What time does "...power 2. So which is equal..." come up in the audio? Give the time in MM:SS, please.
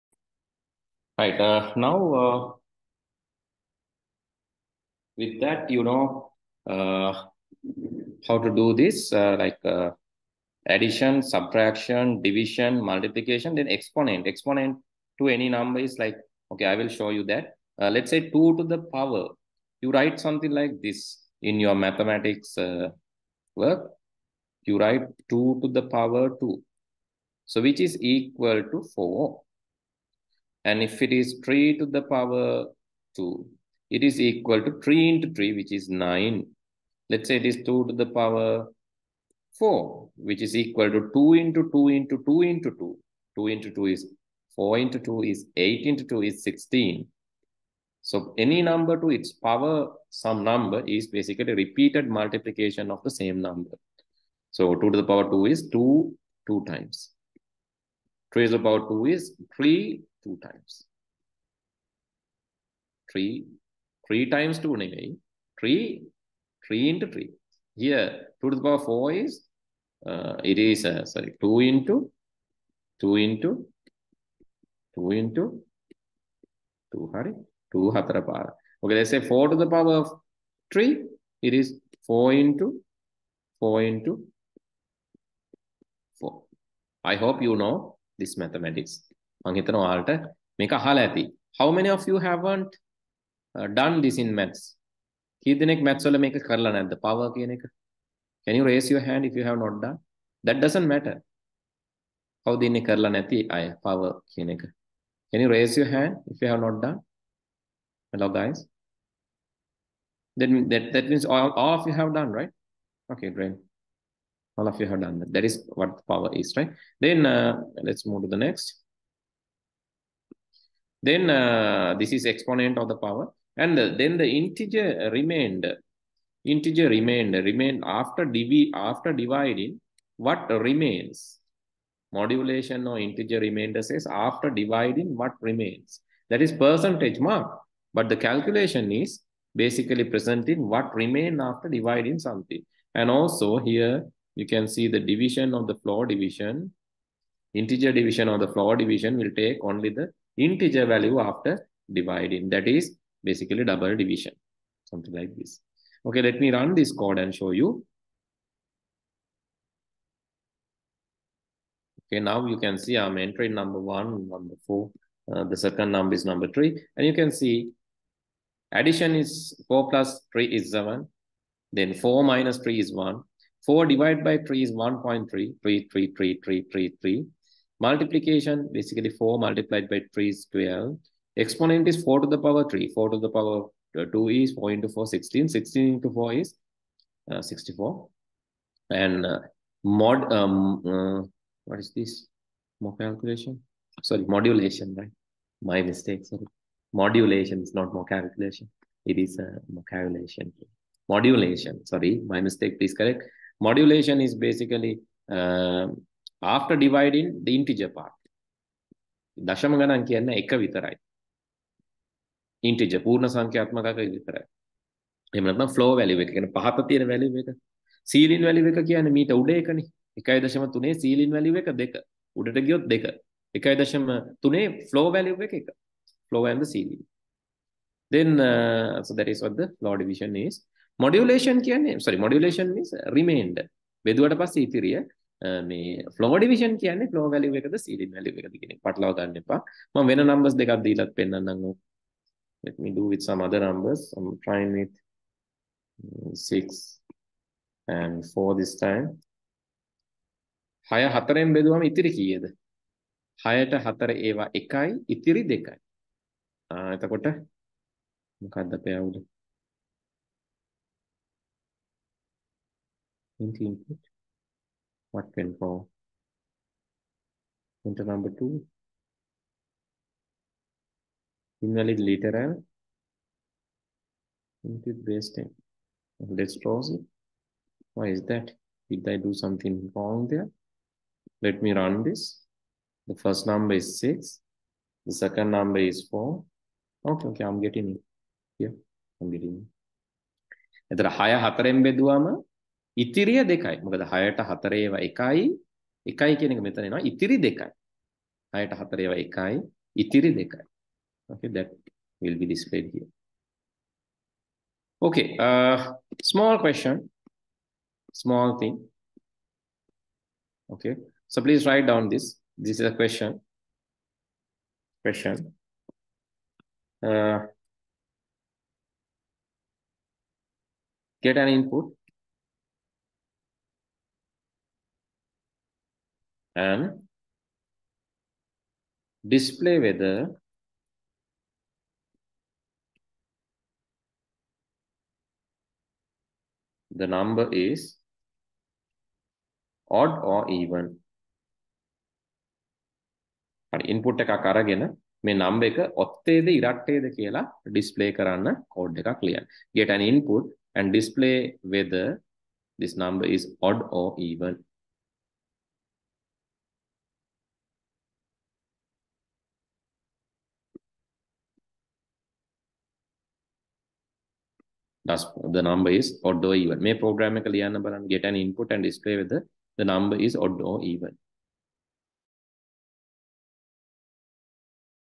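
00:25.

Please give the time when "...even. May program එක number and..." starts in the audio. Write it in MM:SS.
06:06.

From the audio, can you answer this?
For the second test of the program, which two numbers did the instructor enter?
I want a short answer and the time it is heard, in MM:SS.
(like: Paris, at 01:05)
6 and 4, at 04:06.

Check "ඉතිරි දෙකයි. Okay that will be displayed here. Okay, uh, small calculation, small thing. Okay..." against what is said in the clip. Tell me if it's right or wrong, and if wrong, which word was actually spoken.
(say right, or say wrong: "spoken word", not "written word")
wrong: "question", not "calculation".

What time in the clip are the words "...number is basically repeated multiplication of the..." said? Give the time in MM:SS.
00:50.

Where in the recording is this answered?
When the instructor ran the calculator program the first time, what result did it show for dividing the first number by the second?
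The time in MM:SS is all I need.
02:54.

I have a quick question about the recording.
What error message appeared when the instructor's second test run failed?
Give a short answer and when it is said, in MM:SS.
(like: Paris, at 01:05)
Invalid literal, at 04:31.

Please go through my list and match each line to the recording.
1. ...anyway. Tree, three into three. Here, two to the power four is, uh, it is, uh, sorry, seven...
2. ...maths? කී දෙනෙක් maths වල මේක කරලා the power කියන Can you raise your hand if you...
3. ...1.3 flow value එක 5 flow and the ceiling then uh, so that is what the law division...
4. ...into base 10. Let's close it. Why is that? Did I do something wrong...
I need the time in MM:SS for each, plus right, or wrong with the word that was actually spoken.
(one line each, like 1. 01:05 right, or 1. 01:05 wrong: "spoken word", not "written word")
1. 01:04 wrong: "two", not "seven"
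2. 01:34 right
3. 03:44 wrong: "1", not "5"
4. 04:34 right.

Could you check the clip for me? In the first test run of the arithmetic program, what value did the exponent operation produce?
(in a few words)
64.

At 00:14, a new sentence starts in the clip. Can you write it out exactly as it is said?
Exponent to any number is like, okay, I will show you that.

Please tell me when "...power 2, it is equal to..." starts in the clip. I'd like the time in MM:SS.
00:32.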